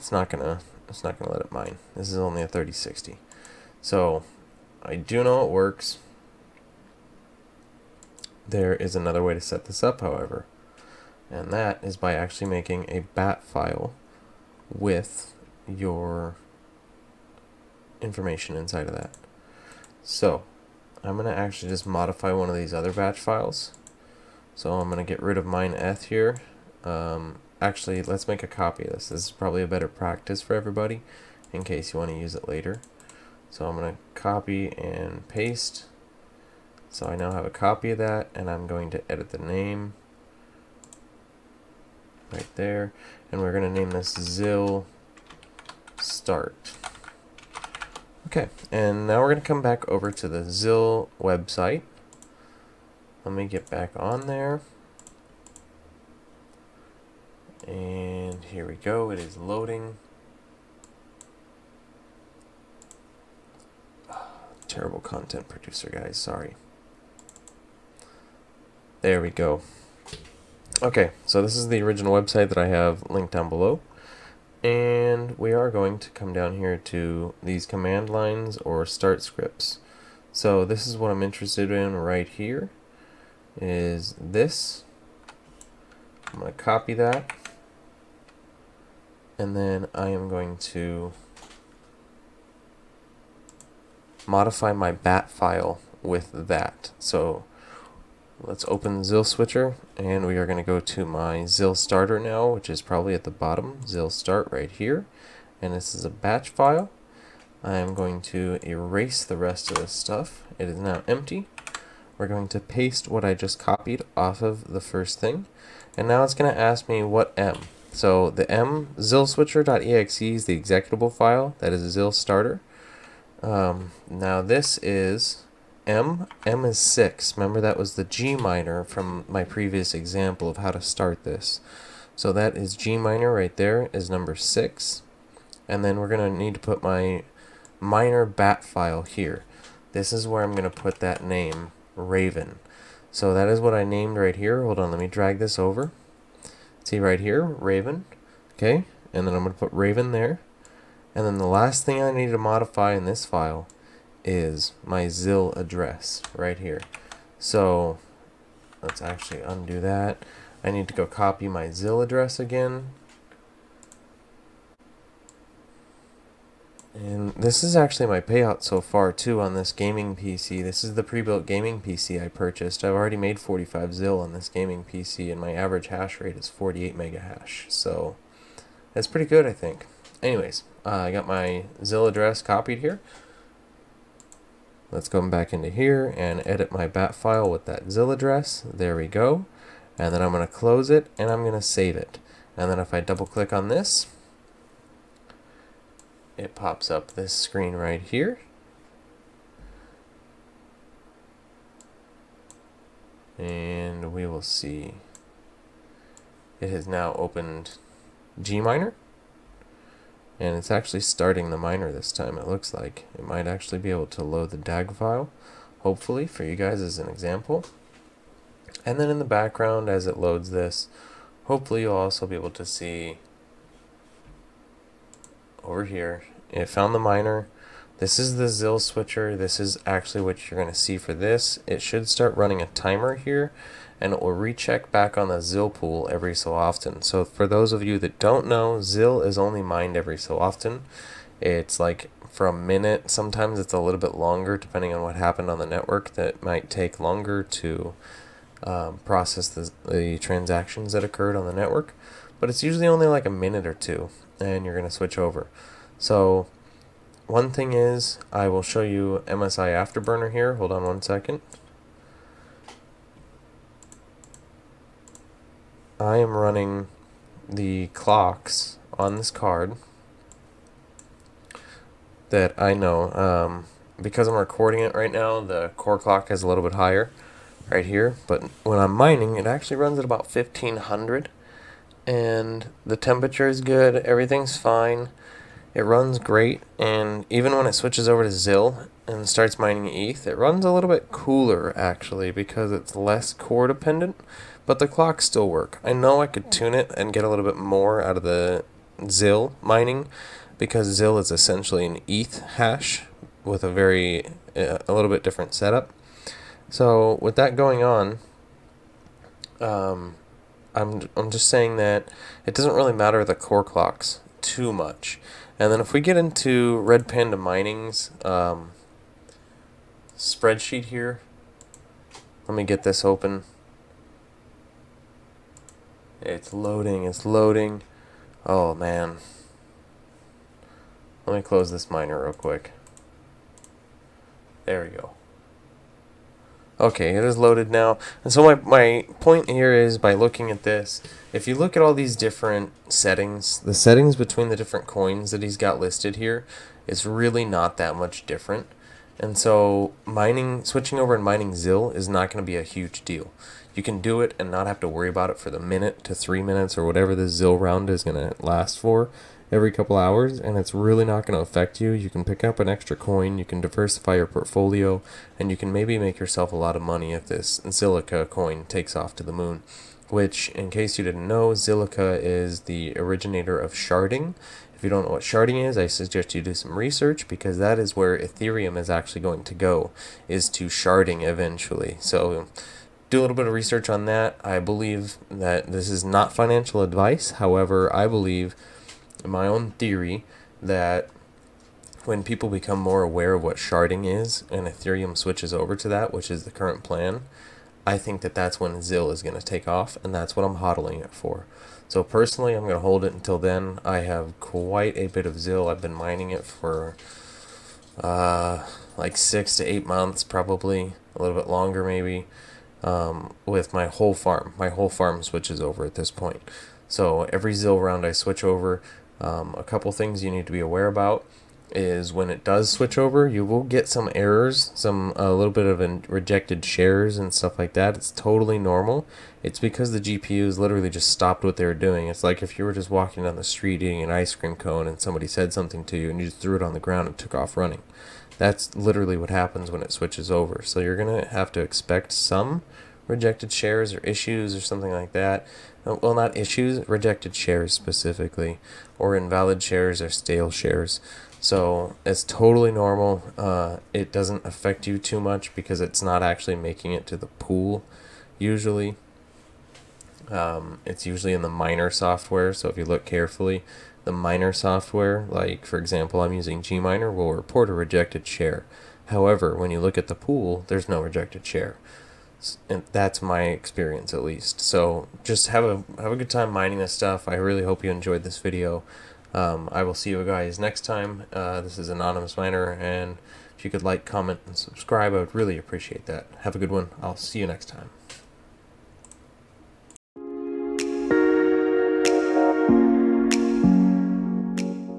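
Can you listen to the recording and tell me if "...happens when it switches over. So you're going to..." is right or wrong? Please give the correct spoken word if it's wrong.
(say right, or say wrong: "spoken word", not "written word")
right.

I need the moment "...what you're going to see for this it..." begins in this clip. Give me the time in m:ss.
3:50.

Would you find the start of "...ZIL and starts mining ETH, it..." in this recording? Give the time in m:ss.
4:48.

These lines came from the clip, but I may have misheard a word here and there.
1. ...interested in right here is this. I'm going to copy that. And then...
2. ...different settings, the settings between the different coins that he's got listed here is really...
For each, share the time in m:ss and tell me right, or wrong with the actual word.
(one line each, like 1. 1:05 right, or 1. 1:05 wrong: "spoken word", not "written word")
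1. 1:21 right
2. 5:42 right.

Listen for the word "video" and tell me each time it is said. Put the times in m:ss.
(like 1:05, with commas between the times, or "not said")
7:58.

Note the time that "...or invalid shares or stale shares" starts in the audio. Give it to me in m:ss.
7:28.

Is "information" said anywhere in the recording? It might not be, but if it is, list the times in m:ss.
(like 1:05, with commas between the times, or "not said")
0:18.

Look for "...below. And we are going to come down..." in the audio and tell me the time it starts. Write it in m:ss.
1:13.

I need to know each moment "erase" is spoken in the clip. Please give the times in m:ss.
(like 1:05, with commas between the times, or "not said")
1:48.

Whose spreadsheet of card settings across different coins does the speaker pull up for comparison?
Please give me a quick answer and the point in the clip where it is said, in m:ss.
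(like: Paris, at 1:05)
Red Panda Mining, at 5:16.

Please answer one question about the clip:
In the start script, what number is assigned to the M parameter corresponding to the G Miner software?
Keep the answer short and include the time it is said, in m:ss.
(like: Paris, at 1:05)
6, at 2:06.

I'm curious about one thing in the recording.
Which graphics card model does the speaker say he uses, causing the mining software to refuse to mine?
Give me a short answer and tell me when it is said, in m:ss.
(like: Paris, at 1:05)
3060, at 0:02.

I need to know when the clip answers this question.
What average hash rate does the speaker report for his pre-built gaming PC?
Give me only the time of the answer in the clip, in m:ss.
2:56.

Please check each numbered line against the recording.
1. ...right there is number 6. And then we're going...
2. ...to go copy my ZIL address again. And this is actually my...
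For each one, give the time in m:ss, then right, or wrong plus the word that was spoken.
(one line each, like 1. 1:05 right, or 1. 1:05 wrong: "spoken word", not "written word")
1. 2:13 right
2. 2:40 right.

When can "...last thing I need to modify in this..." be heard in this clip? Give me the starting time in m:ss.
2:31.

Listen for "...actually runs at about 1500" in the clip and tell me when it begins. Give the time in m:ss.
4:39.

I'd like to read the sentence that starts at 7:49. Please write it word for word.
However, when you look at the pool, there's no rejected share.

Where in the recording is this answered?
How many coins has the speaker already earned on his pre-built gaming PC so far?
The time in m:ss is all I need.
2:53.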